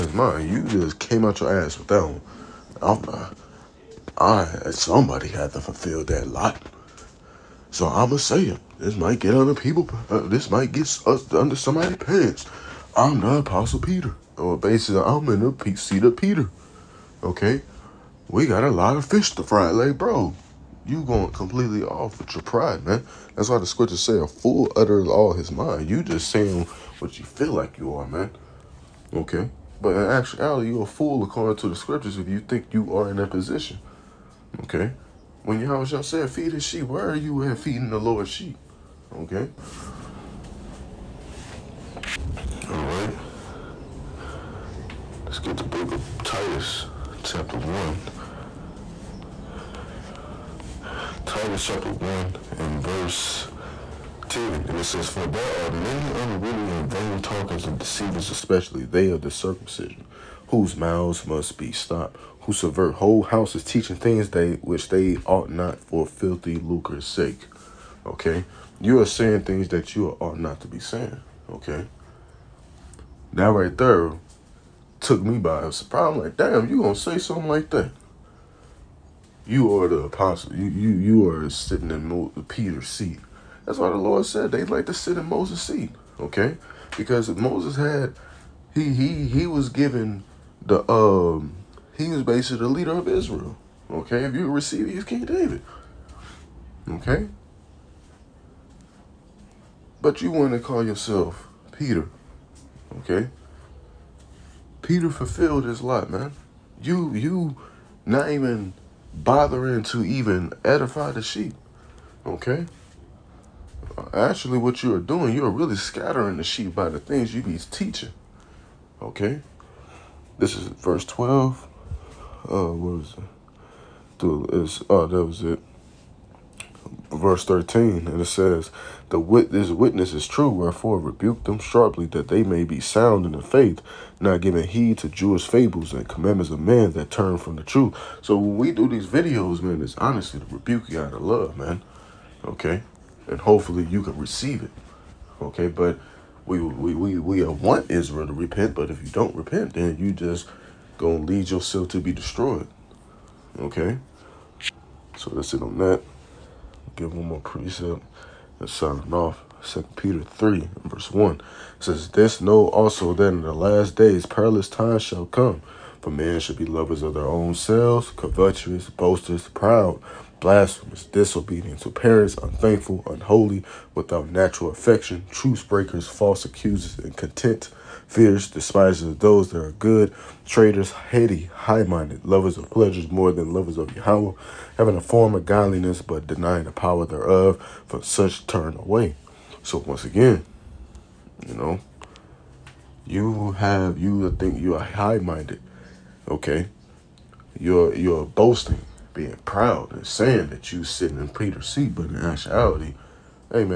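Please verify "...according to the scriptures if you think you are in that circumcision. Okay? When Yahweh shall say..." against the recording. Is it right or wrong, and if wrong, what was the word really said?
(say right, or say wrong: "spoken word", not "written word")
wrong: "position", not "circumcision".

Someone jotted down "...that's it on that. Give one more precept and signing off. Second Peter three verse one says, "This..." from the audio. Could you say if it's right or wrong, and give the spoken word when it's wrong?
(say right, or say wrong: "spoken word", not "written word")
right.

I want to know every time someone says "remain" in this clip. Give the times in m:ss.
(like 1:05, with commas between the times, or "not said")
not said.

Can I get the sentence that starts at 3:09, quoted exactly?
So once again, you know, you have, you think you are high-minded, okay?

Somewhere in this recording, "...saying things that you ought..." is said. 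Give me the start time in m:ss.
1:09.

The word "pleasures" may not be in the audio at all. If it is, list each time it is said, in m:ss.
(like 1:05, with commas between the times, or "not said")
3:02.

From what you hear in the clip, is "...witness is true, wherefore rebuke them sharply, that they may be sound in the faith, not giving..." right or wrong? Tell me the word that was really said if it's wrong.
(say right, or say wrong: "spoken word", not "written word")
right.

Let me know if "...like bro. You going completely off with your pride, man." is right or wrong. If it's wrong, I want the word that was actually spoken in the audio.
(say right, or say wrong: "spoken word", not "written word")
right.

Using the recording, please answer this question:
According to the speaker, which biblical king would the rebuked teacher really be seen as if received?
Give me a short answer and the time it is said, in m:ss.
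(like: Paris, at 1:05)
King David, at 1:35.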